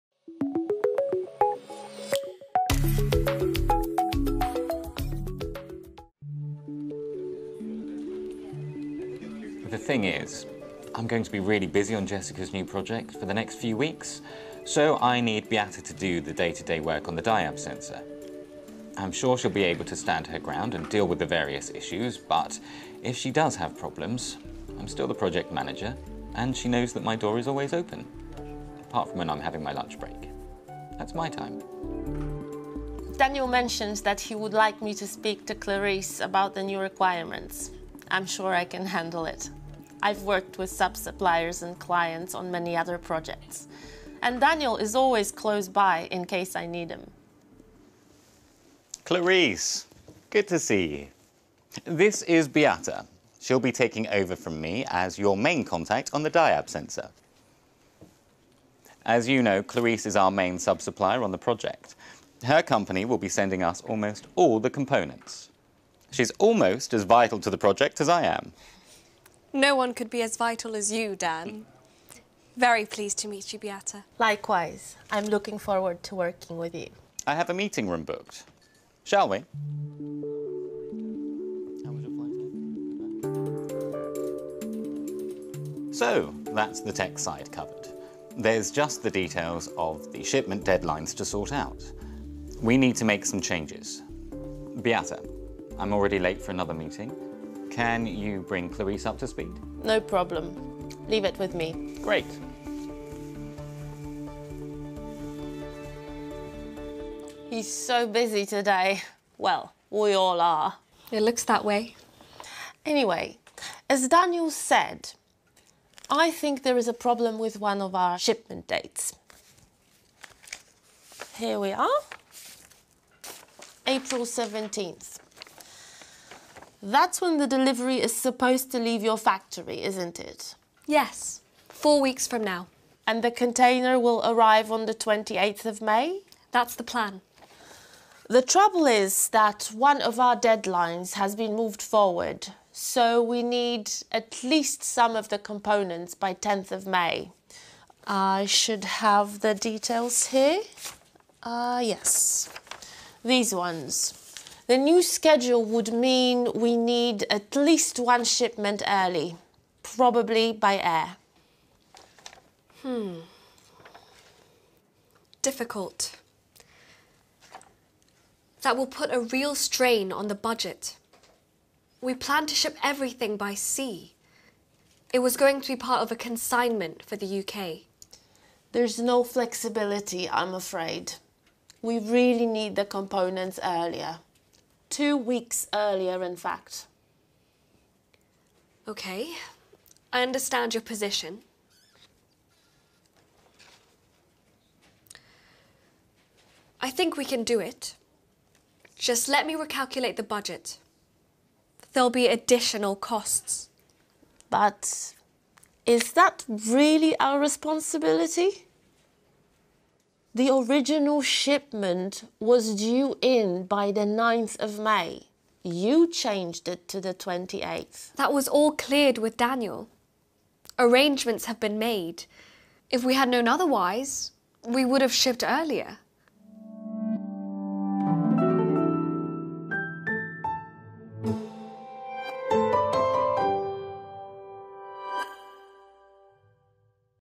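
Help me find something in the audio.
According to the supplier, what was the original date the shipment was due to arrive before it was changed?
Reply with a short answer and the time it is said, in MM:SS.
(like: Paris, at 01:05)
9th of May, at 03:34.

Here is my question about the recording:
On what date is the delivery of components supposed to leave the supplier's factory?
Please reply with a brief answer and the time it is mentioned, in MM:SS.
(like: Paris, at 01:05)
April 17th, at 02:03.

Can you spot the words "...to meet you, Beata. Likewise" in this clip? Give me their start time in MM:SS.
01:13.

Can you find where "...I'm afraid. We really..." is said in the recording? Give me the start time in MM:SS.
03:00.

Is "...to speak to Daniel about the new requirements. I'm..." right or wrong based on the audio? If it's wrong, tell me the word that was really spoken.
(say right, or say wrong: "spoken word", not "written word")
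wrong: "Clarice", not "Daniel".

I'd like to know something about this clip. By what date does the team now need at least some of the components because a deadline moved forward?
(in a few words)
10th of May.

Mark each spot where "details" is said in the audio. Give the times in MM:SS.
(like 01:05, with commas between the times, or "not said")
01:29, 02:29.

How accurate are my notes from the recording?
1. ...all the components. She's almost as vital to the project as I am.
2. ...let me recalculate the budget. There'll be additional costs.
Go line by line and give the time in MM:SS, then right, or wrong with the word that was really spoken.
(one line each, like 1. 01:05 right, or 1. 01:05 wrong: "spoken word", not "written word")
1. 01:04 right
2. 03:19 right.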